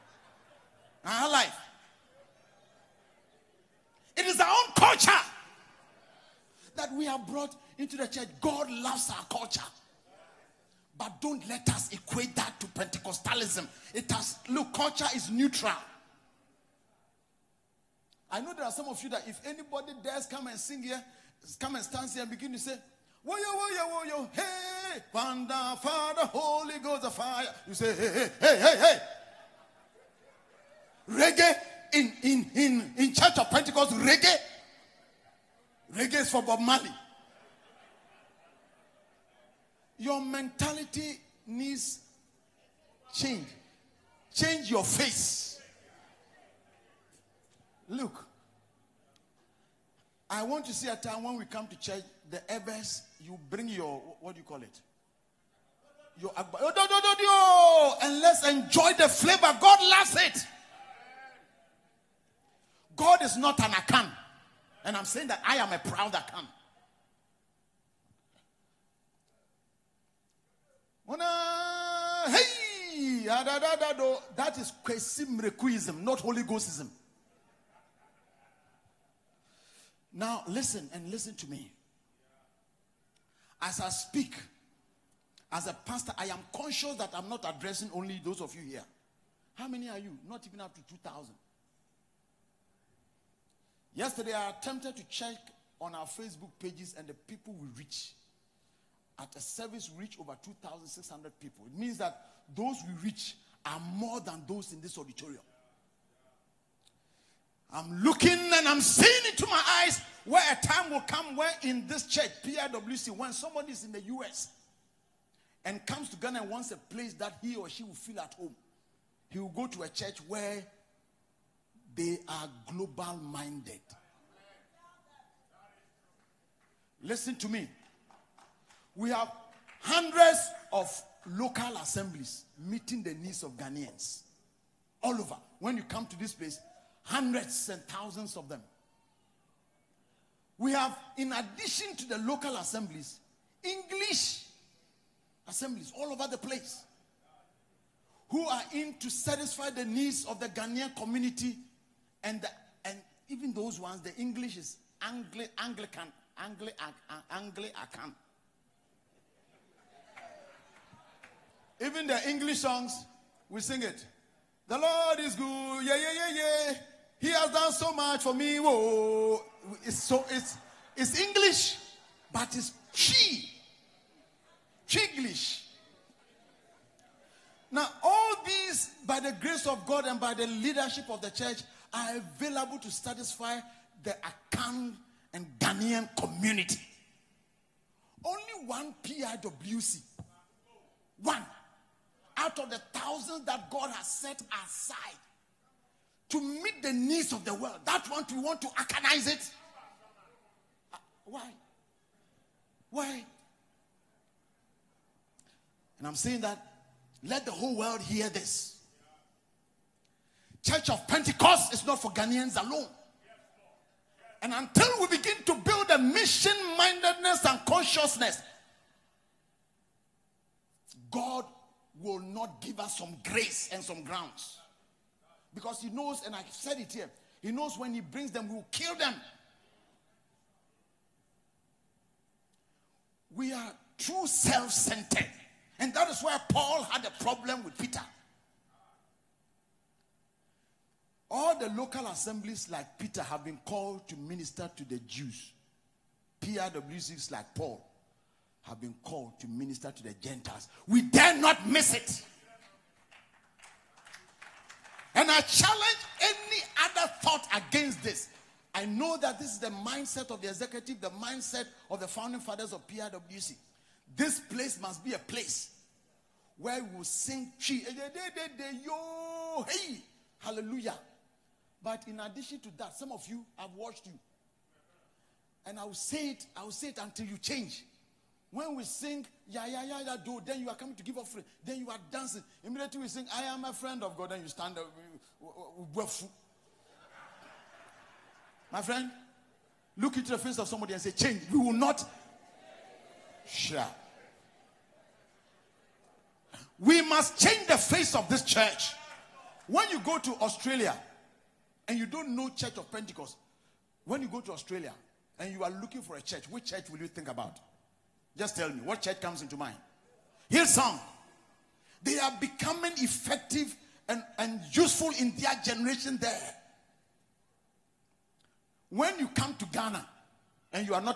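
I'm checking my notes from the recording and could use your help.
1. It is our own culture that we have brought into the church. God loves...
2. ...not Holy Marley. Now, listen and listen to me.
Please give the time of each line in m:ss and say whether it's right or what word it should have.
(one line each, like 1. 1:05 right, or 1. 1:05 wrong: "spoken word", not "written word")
1. 0:04 right
2. 1:16 wrong: "Ghostism", not "Marley".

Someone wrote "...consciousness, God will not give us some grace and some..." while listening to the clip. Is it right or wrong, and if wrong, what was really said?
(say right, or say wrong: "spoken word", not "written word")
right.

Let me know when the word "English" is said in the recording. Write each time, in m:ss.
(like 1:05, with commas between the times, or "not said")
2:23, 2:34, 2:42, 2:51.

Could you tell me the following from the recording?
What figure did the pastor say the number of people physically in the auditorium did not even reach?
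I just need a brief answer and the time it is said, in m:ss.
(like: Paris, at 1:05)
2,000, at 1:30.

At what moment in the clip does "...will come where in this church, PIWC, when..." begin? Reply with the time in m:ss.
1:50.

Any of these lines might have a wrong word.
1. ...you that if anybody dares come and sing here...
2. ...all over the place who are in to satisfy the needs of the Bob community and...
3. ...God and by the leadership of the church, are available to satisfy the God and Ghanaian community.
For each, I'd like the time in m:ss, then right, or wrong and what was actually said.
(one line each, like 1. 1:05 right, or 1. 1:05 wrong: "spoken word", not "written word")
1. 0:19 right
2. 2:25 wrong: "Ghanaian", not "Bob"
3. 2:59 wrong: "Akan", not "God".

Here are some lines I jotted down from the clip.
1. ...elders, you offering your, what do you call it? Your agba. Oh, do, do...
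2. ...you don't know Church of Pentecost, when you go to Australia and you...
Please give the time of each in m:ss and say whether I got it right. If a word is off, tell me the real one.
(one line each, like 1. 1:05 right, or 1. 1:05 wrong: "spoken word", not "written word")
1. 0:52 wrong: "bring", not "offering"
2. 5:01 right.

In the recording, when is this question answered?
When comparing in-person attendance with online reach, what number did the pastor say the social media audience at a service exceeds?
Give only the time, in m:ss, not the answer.
1:40.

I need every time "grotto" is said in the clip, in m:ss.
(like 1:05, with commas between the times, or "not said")
not said.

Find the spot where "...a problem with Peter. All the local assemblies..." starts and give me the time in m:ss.
3:57.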